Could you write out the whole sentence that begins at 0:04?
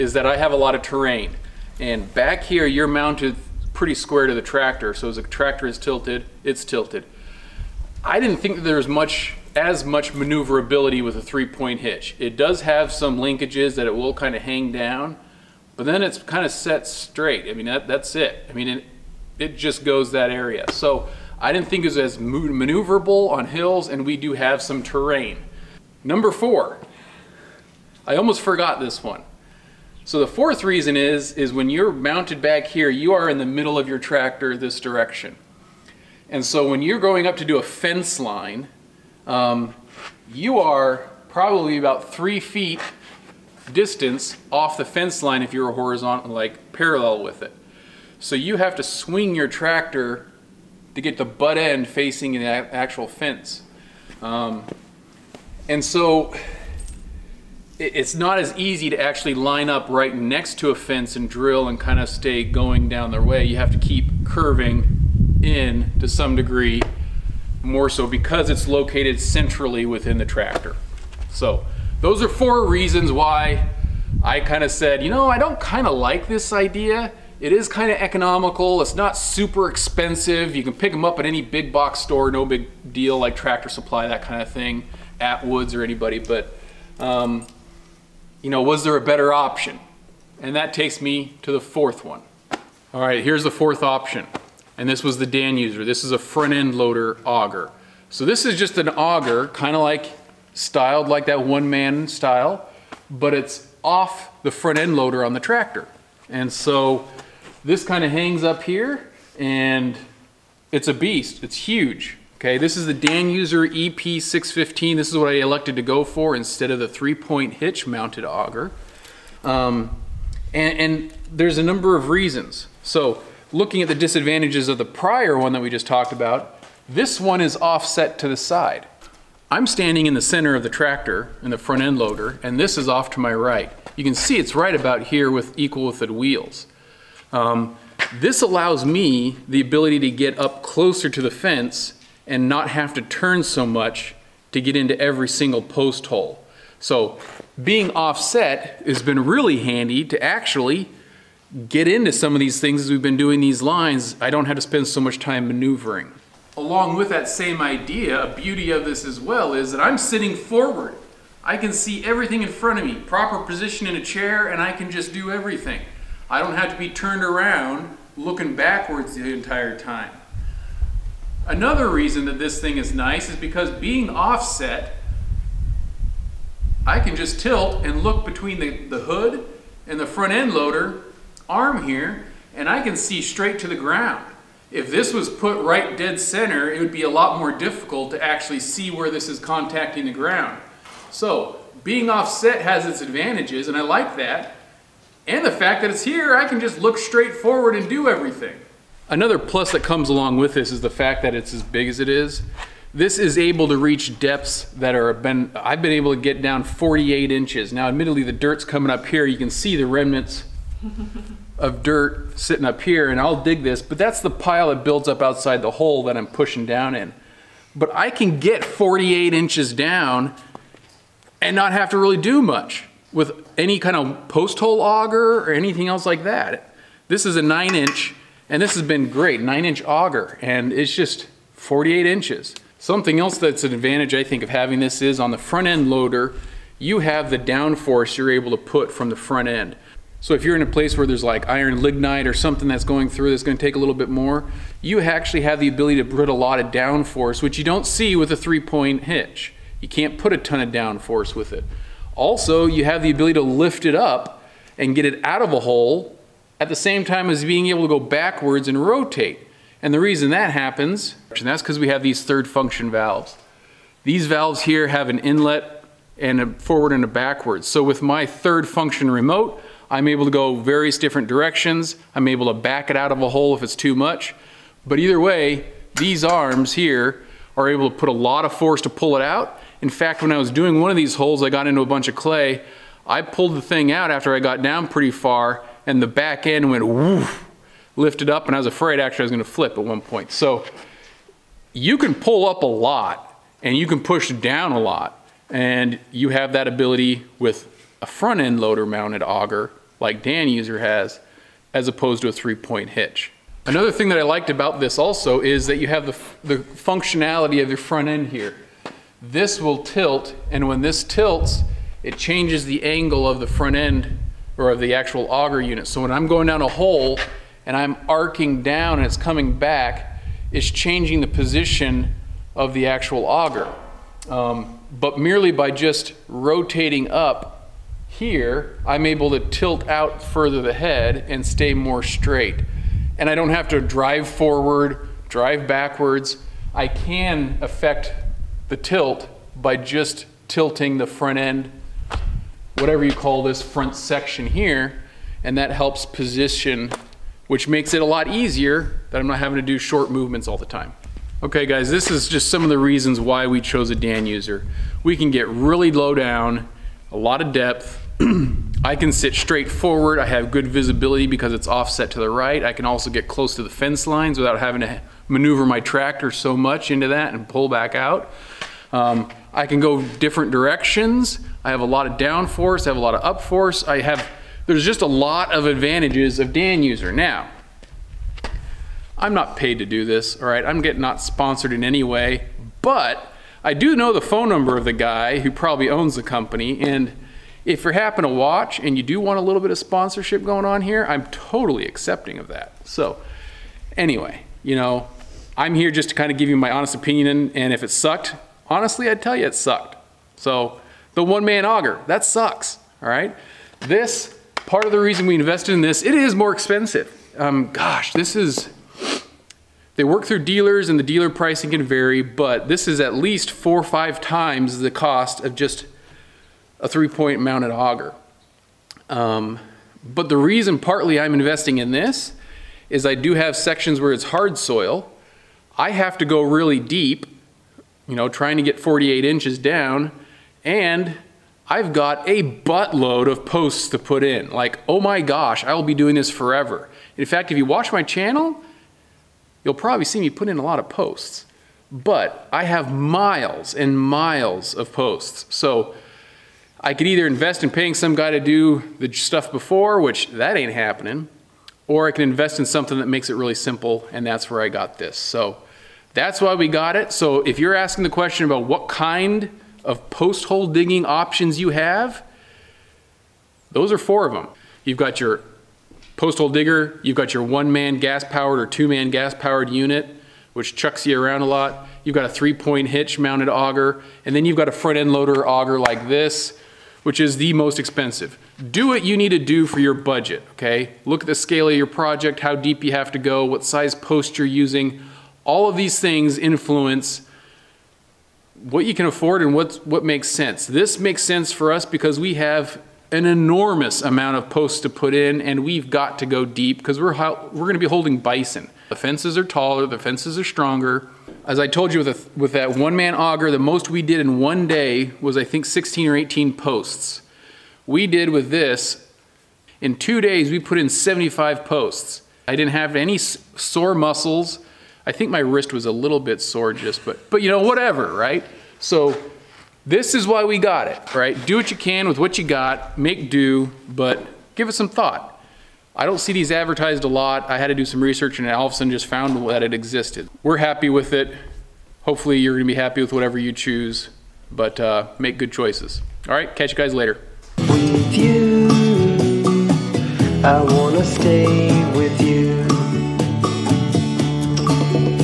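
So as the tractor is tilted, it's tilted.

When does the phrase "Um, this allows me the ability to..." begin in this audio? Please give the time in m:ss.
2:17.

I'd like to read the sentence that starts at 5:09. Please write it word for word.
This will tilt, and when this tilts, it changes the angle of the front end or of the actual auger unit.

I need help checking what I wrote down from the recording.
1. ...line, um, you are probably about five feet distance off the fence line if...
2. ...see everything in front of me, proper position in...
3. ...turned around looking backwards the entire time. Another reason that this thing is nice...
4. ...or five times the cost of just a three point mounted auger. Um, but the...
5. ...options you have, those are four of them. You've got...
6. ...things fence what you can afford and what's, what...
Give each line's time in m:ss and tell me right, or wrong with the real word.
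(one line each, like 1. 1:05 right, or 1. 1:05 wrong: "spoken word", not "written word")
1. 0:38 wrong: "three", not "five"
2. 2:41 right
3. 2:46 right
4. 6:53 right
5. 7:41 right
6. 8:05 wrong: "influence", not "fence".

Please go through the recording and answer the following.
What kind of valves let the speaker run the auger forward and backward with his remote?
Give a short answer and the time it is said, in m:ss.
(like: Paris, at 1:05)
third function valves, at 4:22.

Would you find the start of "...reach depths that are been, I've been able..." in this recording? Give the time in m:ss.
3:23.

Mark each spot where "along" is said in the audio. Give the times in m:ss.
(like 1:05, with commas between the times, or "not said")
2:36, 3:20.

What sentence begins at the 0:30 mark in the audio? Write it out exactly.
So the fourth reason is, is when you're mounted back here, you are in the middle of your tractor this direction.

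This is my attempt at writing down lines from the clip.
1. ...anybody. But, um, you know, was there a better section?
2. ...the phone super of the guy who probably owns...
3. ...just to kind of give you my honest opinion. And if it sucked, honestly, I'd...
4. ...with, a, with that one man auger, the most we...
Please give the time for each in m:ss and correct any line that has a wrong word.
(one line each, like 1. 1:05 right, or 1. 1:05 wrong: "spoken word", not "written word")
1. 1:25 wrong: "option", not "section"
2. 6:24 wrong: "number", not "super"
3. 6:35 right
4. 8:22 right.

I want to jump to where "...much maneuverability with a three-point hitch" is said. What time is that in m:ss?
0:09.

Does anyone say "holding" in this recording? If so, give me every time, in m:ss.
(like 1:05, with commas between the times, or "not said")
8:17.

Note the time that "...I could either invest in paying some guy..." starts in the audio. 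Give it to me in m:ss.
7:26.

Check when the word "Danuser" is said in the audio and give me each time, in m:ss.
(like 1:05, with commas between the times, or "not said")
1:35, 1:52, 5:00, 5:53.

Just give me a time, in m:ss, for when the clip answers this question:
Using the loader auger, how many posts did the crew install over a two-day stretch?
8:30.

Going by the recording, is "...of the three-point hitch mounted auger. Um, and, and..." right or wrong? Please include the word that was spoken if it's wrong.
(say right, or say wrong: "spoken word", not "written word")
right.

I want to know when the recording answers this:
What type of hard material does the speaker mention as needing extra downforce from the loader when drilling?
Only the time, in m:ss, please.
4:01.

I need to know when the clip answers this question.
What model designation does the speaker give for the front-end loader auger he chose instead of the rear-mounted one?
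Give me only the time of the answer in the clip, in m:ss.
1:53.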